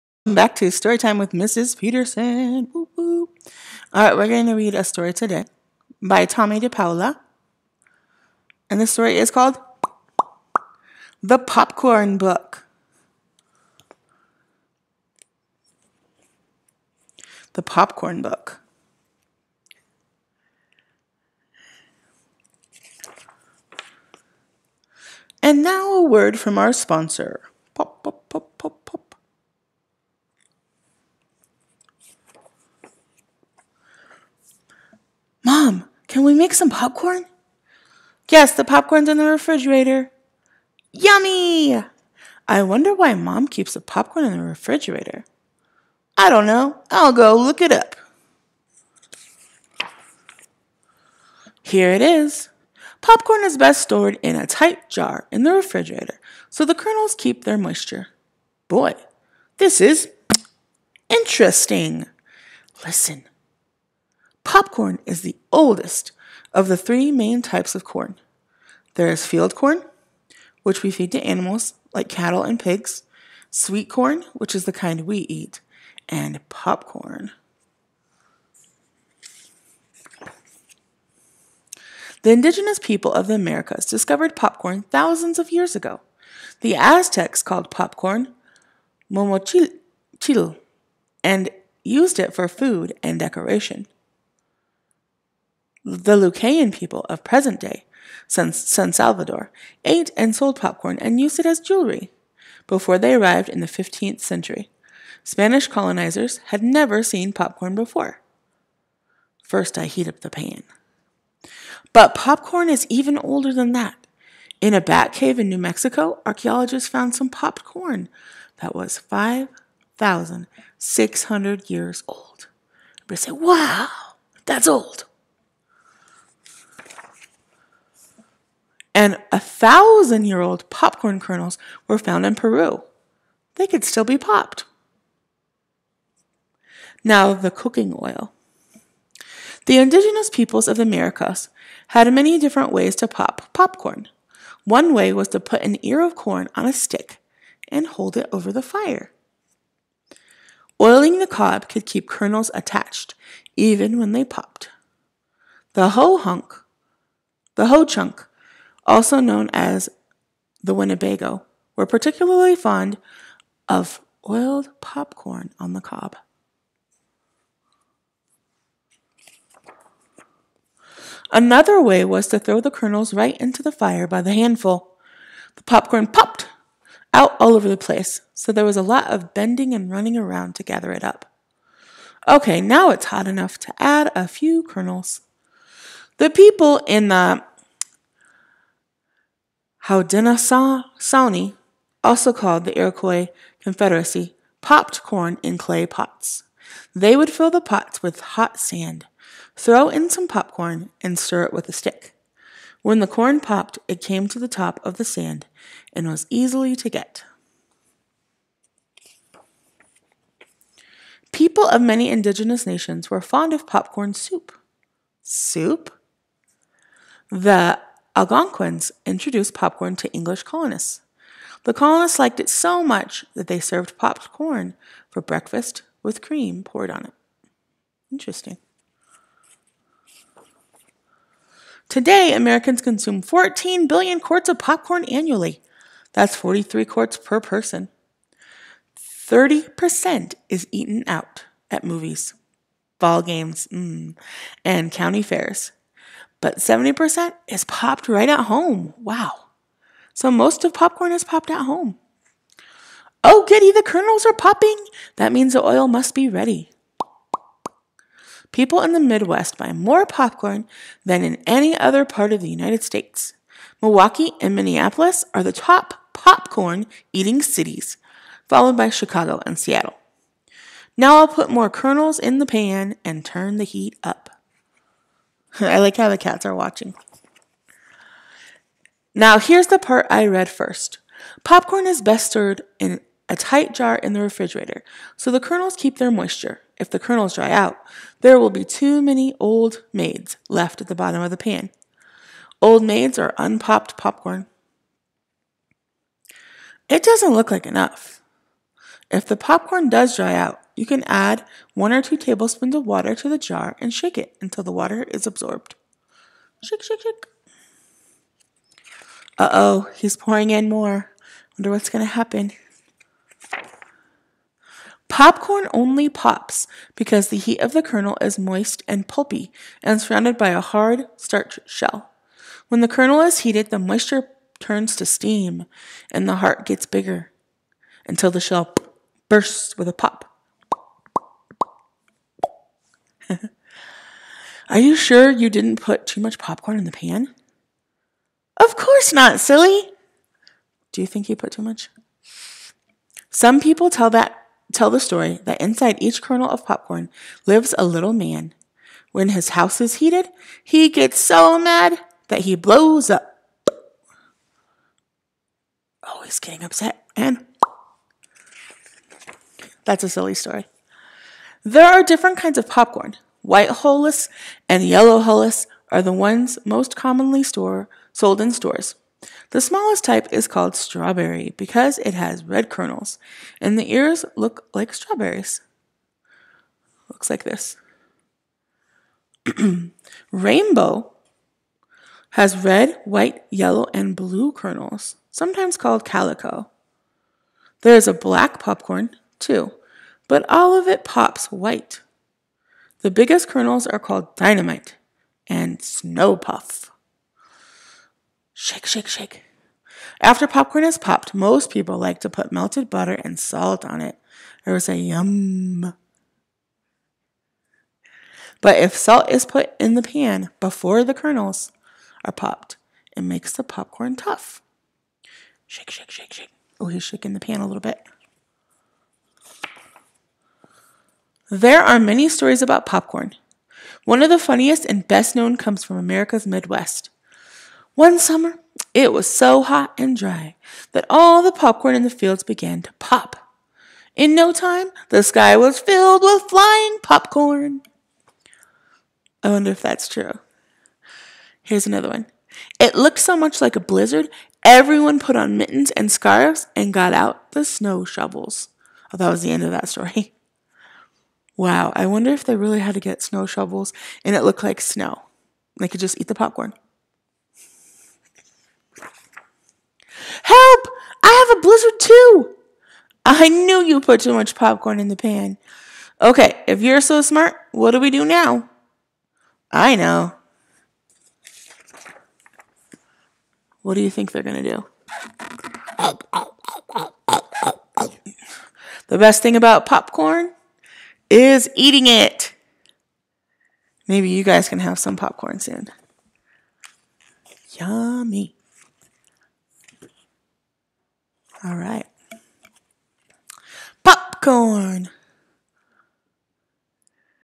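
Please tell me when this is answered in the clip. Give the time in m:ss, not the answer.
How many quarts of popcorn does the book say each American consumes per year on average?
3:56.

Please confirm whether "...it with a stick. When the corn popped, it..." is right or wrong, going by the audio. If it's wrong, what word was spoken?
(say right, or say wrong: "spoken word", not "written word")
right.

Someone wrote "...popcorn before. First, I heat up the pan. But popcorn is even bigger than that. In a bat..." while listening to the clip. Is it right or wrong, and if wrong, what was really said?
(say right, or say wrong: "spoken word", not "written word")
wrong: "older", not "bigger".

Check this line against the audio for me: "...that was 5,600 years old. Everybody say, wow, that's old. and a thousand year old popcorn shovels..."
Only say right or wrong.
wrong.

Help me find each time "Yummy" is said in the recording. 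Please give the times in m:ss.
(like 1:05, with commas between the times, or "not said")
0:40, 8:07.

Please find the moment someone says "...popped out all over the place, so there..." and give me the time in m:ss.
2:56.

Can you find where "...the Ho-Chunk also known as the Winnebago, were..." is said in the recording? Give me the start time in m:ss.
2:37.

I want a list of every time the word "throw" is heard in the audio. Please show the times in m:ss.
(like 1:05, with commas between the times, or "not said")
2:52, 3:19.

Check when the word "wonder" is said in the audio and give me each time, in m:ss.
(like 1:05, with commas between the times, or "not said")
0:42, 5:11, 7:19, 7:32.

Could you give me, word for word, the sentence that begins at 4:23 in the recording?
Milwaukee and Minneapolis are the top popcorn eating cities, followed by Chicago and Seattle.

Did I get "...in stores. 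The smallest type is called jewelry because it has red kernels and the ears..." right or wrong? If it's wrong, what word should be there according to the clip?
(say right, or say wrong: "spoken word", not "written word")
wrong: "strawberry", not "jewelry".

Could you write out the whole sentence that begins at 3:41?
The colonists liked it so much that they served popcorn for breakfast with cream poured on it.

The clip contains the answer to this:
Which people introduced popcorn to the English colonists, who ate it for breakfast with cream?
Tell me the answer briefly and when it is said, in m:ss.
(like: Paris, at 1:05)
Algonquins, at 3:37.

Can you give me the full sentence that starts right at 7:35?
They could just eat the popcorn.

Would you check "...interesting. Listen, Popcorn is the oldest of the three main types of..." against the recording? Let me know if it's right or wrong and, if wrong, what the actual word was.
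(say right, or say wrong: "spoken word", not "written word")
right.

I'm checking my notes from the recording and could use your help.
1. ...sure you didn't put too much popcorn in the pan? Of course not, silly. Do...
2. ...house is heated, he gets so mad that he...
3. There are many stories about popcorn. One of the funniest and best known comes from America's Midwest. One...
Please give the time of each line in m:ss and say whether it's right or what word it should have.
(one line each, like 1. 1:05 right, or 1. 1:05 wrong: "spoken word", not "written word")
1. 5:34 right
2. 5:49 right
3. 7:01 right.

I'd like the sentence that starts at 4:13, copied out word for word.
Oh, goody, the kernels are popping.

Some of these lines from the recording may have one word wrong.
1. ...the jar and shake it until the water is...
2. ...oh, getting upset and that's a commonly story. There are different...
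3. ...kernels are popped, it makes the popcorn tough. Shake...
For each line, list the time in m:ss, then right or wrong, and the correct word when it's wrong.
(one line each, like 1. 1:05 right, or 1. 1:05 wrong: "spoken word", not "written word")
1. 5:03 right
2. 5:56 wrong: "silly", not "commonly"
3. 6:51 right.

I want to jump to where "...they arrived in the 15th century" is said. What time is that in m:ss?
1:42.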